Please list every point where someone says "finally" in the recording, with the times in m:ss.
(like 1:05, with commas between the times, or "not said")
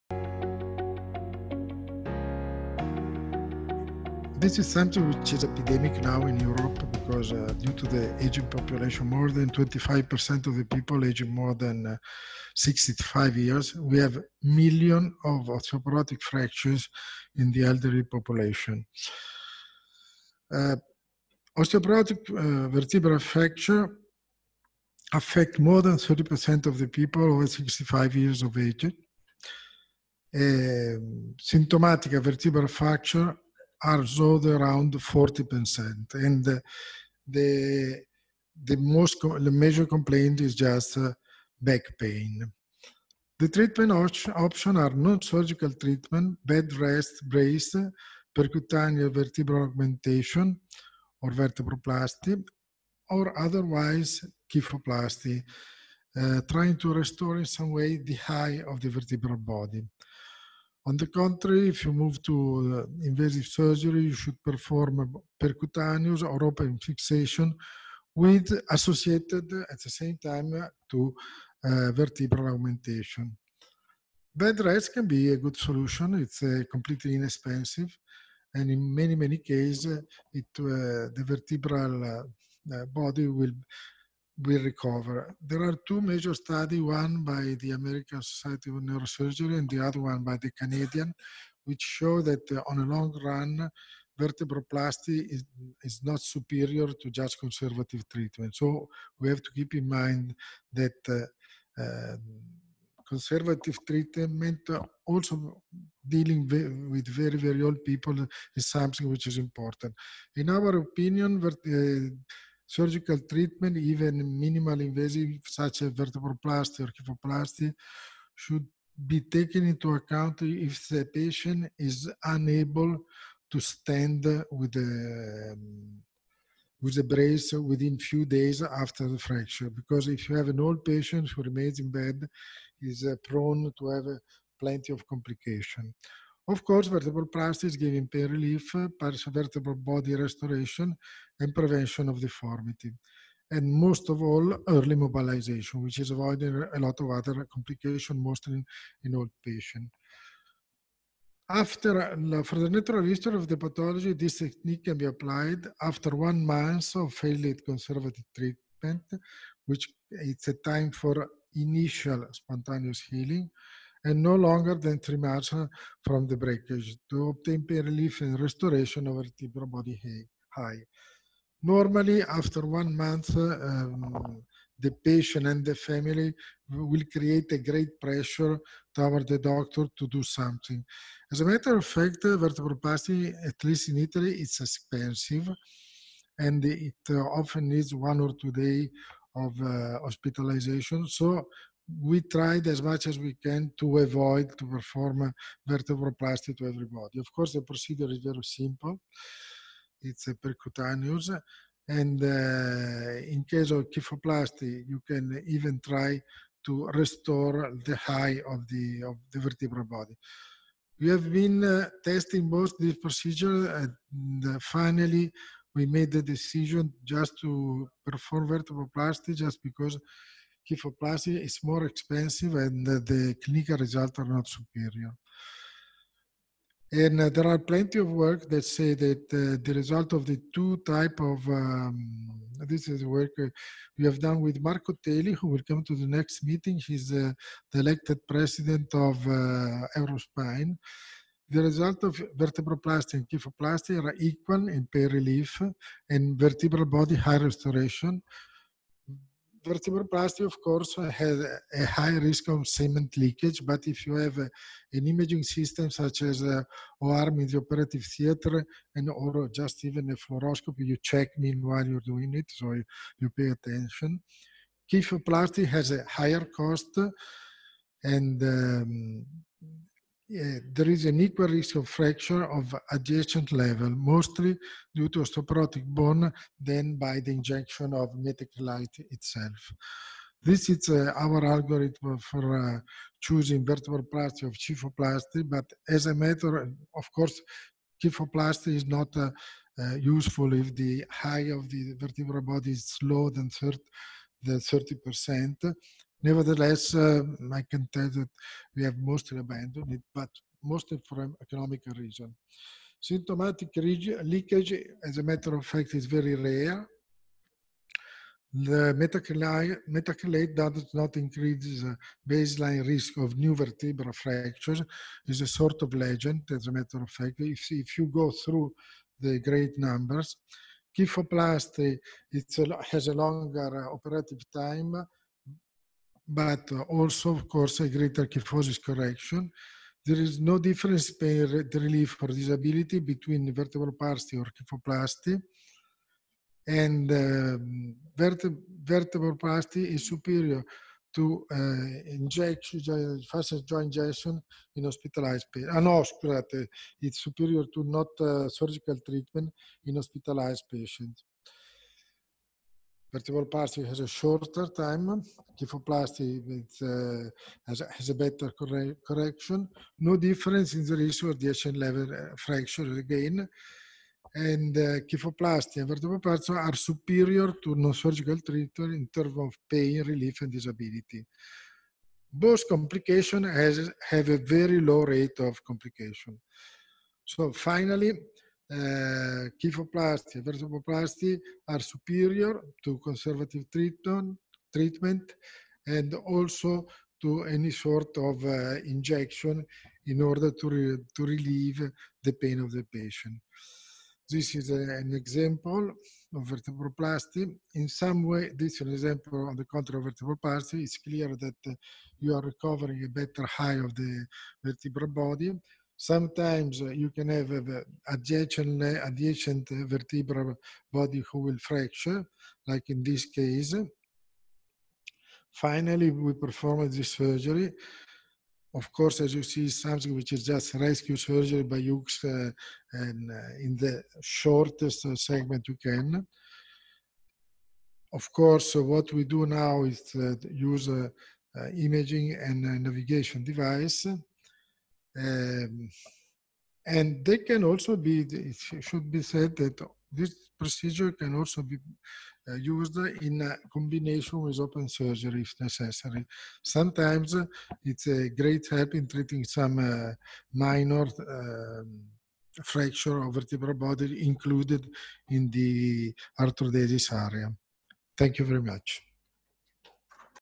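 3:34, 6:17, 6:55.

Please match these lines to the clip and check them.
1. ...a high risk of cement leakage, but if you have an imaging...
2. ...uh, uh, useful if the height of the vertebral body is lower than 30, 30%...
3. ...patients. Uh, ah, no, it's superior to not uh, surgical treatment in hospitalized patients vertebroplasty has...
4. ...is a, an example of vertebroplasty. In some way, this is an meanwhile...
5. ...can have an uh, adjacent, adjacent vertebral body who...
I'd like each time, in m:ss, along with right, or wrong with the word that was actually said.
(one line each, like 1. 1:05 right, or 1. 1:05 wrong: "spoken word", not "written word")
1. 4:11 right
2. 4:49 right
3. 5:45 right
4. 6:34 wrong: "example", not "meanwhile"
5. 6:47 right.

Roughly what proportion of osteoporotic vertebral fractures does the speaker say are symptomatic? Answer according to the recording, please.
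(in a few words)
40%.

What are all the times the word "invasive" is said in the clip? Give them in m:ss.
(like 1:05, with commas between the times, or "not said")
1:03, 1:54.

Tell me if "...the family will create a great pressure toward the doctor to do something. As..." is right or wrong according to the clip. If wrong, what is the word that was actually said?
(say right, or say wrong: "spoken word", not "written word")
right.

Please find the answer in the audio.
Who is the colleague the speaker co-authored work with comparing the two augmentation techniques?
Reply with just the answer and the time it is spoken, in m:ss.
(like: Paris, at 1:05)
Marco Teli, at 3:54.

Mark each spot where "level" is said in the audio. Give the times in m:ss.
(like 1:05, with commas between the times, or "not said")
4:33, 6:01.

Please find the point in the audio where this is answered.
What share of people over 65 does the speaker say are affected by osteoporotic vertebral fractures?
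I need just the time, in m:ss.
0:25.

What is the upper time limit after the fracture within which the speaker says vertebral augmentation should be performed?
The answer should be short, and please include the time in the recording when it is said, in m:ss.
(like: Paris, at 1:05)
3 months, at 2:44.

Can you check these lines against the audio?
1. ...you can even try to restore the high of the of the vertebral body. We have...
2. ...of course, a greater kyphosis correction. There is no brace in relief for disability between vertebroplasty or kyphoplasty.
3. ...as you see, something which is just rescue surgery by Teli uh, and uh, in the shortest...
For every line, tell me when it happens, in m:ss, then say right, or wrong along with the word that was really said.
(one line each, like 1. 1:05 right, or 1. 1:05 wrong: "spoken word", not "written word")
1. 3:24 right
2. 5:27 wrong: "difference", not "brace"
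3. 6:59 wrong: "Hughes", not "Teli".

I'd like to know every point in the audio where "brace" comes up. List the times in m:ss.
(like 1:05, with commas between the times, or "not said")
0:47, 2:07.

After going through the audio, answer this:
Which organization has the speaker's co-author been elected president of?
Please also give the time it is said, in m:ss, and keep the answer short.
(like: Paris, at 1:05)
Eurospine, at 3:59.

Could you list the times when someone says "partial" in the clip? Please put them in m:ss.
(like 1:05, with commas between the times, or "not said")
2:18.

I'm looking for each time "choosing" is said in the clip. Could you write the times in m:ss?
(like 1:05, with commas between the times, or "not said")
4:43.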